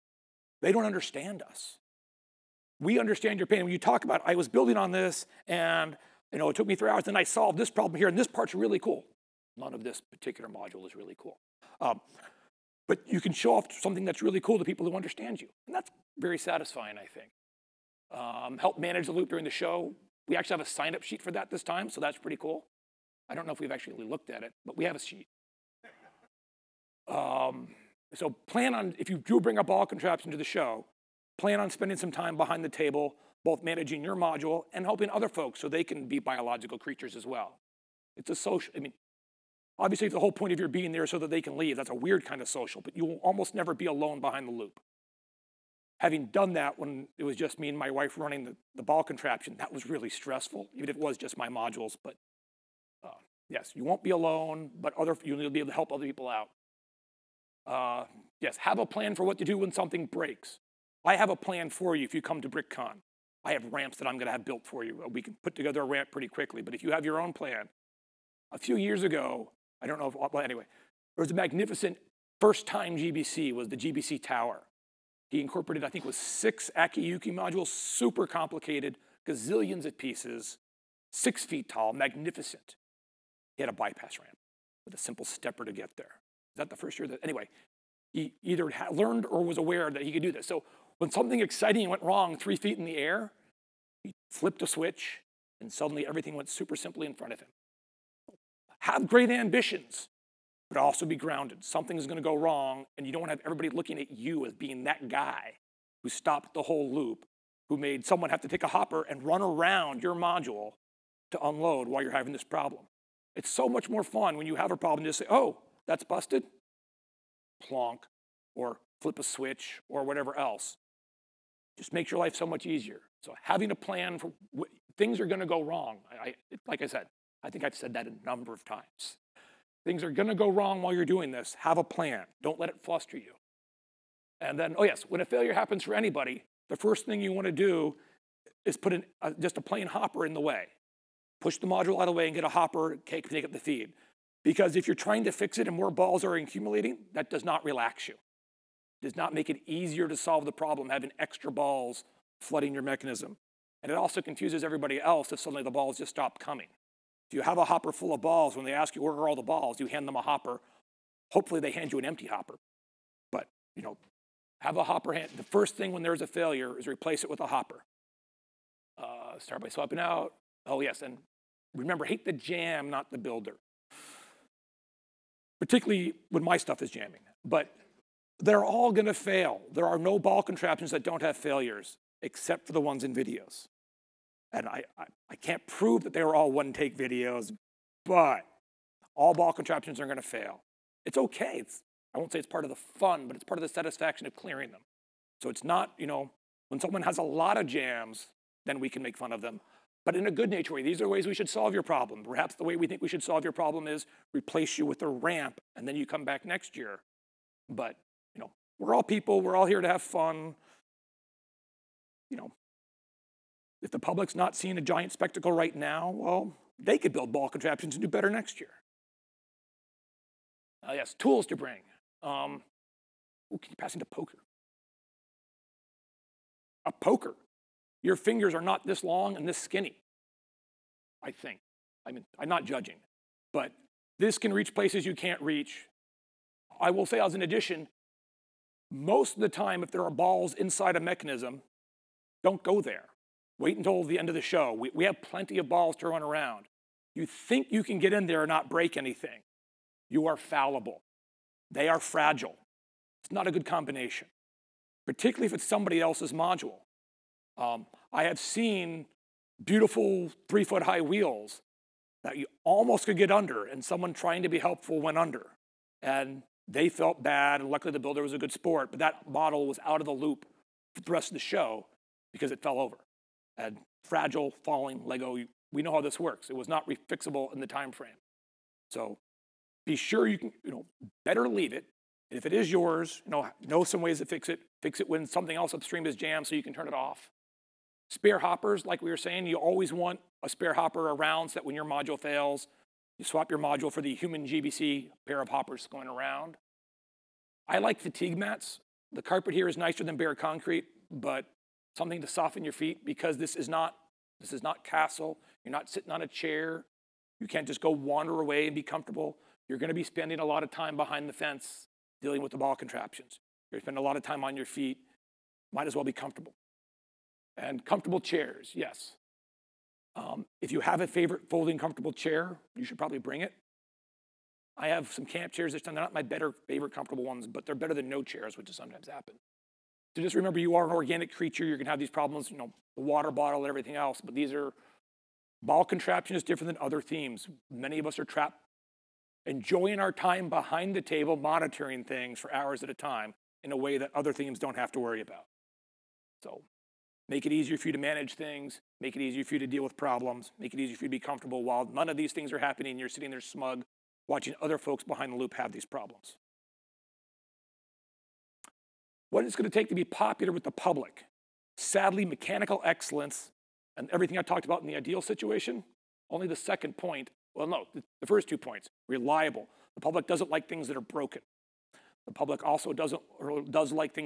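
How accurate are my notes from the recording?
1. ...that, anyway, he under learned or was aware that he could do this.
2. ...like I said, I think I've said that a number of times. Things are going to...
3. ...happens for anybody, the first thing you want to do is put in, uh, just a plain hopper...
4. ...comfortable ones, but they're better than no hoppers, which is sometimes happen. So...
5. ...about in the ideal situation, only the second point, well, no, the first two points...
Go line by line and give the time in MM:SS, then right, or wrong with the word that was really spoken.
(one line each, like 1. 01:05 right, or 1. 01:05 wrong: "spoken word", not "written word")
1. 01:27 wrong: "either", not "under"
2. 02:06 right
3. 02:15 right
4. 05:26 wrong: "chairs", not "hoppers"
5. 06:04 right.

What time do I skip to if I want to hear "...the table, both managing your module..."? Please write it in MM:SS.
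00:32.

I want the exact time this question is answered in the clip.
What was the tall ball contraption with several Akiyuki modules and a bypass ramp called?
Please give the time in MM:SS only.
01:13.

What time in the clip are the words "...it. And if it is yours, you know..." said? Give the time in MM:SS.
04:41.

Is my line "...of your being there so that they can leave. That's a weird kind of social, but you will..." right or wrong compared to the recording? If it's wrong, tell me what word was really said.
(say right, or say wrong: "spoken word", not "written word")
right.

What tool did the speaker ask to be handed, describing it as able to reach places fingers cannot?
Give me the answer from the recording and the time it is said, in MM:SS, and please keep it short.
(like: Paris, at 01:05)
A poker, at 03:46.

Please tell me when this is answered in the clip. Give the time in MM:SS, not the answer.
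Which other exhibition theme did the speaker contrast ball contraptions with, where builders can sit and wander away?
05:04.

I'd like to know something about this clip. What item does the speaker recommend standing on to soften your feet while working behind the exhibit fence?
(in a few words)
Fatigue mats.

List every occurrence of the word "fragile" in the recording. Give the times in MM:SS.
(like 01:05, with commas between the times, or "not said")
04:11, 04:34.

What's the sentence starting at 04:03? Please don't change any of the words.
Wait until the end of the show.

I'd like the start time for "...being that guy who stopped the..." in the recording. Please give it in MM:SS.
01:44.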